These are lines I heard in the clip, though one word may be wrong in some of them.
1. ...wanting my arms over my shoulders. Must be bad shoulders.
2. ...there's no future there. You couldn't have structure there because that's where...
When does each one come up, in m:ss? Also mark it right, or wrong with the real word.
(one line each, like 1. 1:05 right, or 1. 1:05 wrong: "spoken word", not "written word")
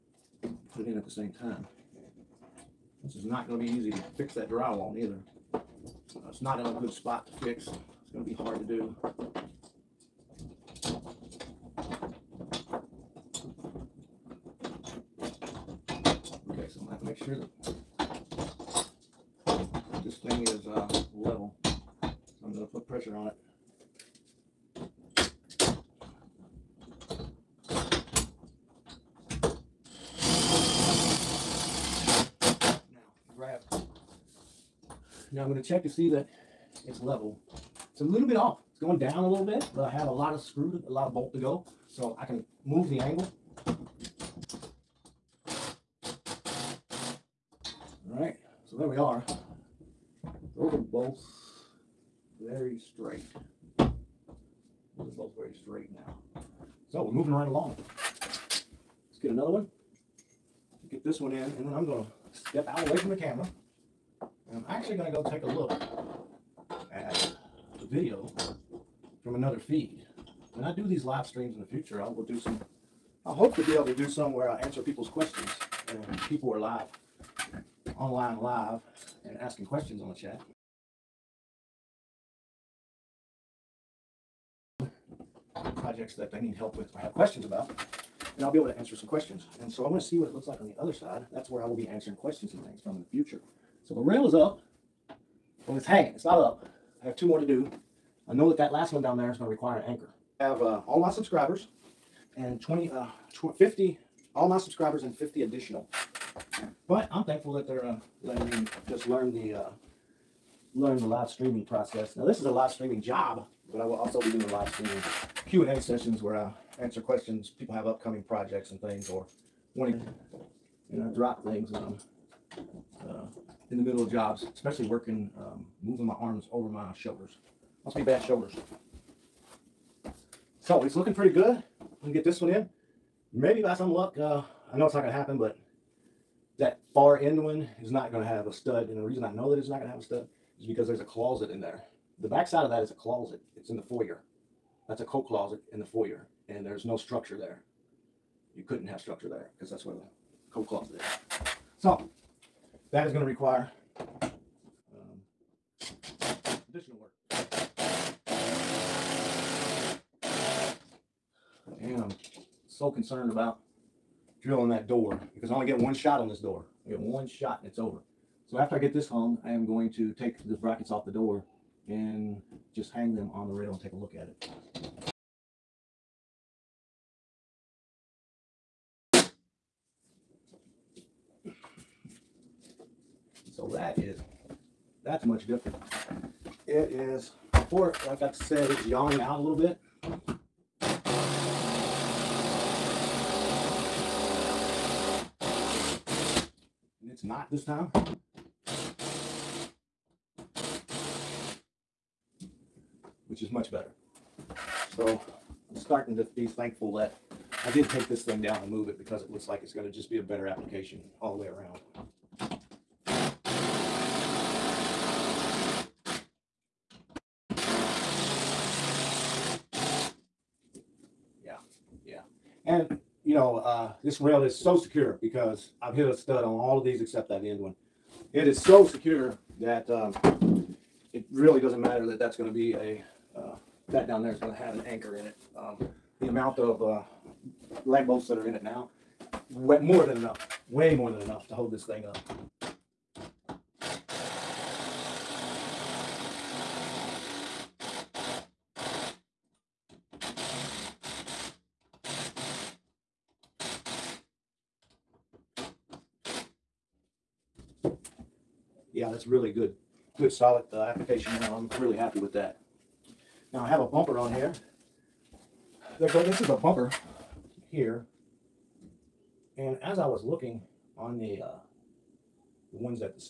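1. 2:05 wrong: "moving", not "wanting"
2. 2:26 wrong: "structure", not "future".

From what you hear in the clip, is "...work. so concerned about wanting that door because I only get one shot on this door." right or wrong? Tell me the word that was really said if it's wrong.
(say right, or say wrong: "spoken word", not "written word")
wrong: "drilling", not "wanting".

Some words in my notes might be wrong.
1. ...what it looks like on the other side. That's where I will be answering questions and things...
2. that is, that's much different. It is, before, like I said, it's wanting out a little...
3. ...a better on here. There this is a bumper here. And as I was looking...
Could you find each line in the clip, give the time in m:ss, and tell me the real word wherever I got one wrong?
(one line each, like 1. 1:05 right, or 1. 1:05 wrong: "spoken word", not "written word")
1. 1:30 right
2. 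3:03 wrong: "yawning", not "wanting"
3. 4:23 wrong: "bumper", not "better".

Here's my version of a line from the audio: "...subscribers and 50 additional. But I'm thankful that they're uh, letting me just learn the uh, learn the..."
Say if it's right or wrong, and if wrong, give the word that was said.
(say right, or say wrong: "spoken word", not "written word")
right.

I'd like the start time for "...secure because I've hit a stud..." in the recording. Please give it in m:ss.
3:44.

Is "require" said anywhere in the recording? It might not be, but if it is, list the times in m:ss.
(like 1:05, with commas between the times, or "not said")
1:39, 2:33.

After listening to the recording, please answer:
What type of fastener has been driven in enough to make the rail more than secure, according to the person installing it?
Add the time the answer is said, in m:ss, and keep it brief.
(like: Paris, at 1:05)
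lag bolts, at 3:57.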